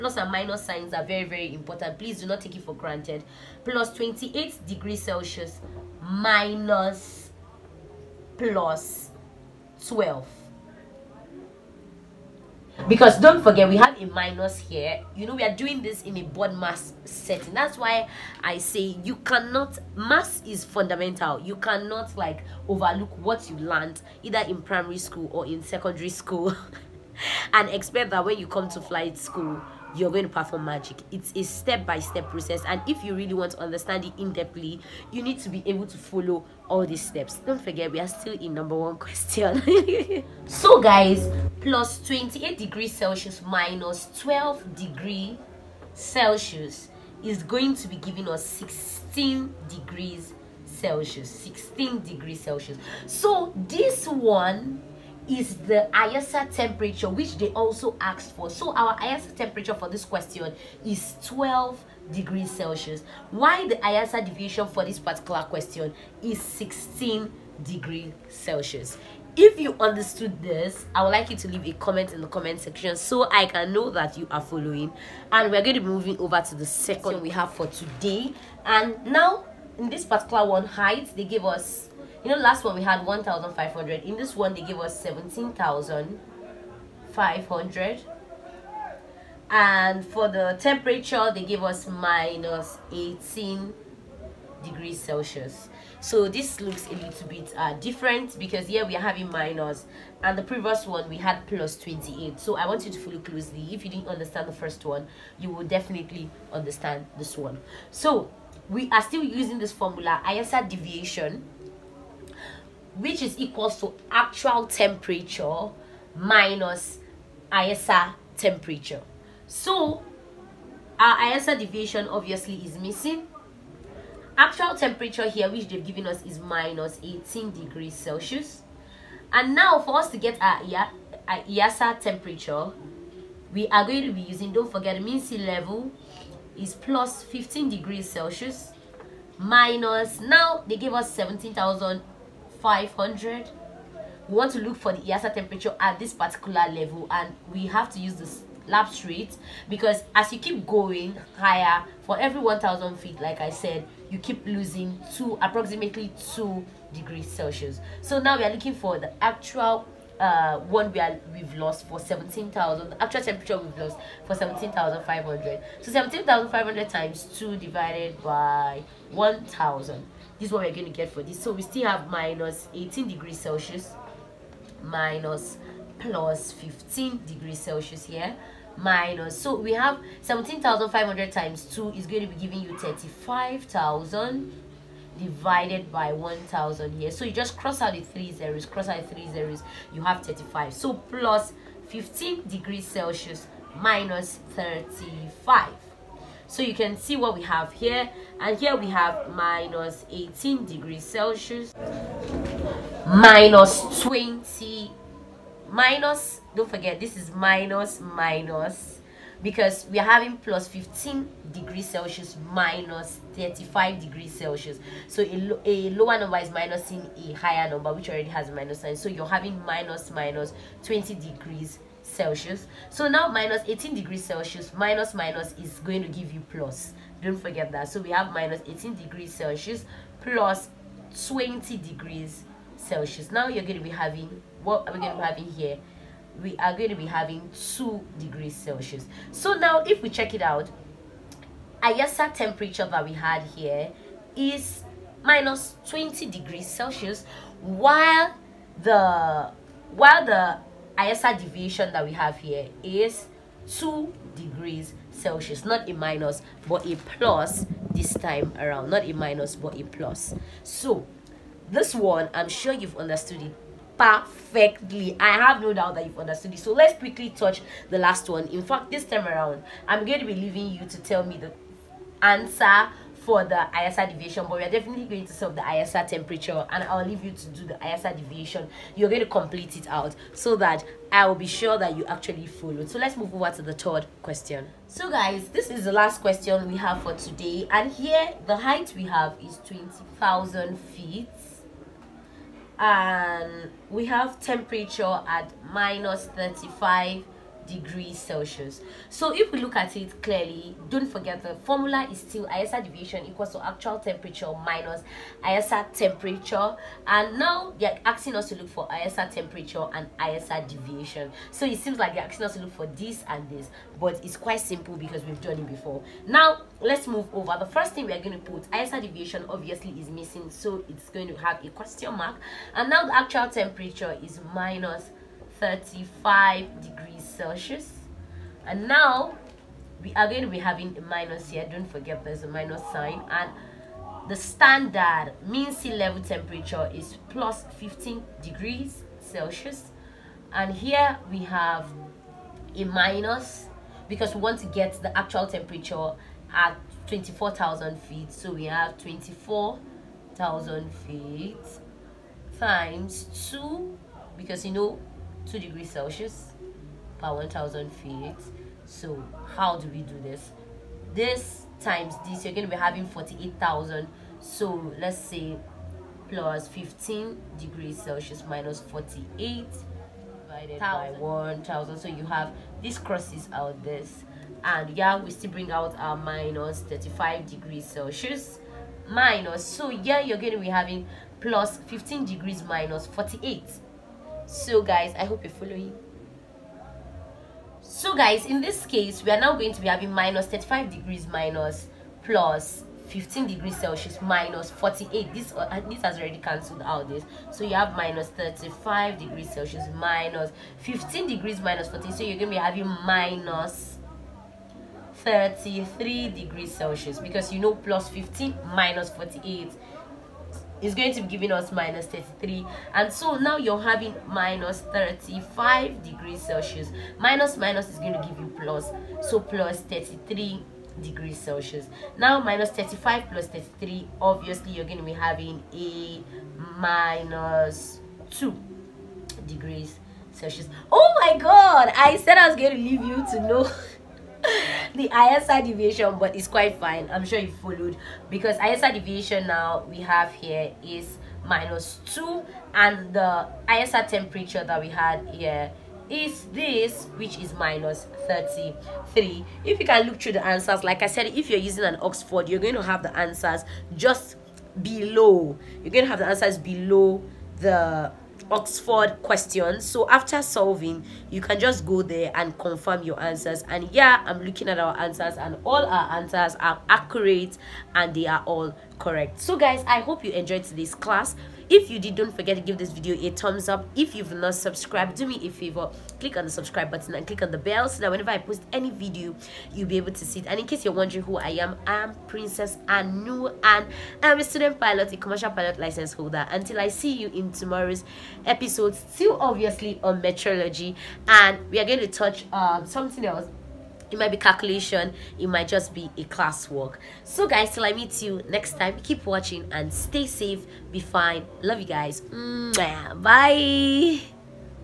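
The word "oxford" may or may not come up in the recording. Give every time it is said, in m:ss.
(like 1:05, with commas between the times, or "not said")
7:32, 7:38.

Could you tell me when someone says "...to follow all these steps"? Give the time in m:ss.
0:35.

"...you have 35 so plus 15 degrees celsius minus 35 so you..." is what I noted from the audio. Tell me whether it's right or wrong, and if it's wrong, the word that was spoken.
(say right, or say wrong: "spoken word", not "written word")
right.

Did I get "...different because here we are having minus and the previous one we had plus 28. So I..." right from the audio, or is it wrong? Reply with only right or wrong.
right.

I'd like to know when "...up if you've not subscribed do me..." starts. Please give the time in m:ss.
7:53.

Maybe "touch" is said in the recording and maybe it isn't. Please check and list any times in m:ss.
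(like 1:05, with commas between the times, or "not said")
4:27, 8:12.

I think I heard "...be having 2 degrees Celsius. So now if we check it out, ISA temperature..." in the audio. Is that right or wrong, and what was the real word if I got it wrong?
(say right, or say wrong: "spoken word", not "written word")
right.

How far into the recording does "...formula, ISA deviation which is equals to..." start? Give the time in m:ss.
1:49.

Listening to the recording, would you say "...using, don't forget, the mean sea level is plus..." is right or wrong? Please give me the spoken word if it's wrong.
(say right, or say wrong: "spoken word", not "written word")
right.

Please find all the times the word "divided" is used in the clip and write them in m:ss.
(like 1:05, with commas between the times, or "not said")
2:47, 3:05, 6:09.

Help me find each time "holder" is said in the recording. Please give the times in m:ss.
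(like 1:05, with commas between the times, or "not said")
8:06.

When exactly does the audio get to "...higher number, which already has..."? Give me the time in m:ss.
3:37.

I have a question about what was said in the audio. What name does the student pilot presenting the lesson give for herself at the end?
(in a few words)
Princess Anu.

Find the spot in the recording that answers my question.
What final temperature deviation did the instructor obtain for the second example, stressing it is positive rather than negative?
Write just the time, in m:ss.
4:13.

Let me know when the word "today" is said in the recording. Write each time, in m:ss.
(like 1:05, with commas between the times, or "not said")
1:17, 4:47.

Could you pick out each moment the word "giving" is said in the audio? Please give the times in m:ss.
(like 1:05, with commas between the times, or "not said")
0:47, 3:02, 6:51.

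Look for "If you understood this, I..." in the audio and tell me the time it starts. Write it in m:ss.
1:09.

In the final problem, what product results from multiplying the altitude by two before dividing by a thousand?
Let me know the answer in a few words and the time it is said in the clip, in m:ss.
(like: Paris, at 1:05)
48,000, at 6:03.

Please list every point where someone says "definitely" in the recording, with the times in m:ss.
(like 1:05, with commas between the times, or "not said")
1:45, 4:34.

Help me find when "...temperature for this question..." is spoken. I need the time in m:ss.
0:59.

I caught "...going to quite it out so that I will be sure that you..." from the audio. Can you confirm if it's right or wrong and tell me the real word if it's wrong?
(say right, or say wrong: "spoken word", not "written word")
wrong: "complete", not "quite".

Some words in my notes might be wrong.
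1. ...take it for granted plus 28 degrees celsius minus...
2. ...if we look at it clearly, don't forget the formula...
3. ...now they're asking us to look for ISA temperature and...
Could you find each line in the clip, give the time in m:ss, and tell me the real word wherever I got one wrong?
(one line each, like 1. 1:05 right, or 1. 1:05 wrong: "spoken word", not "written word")
1. 0:02 right
2. 4:59 right
3. 5:07 right.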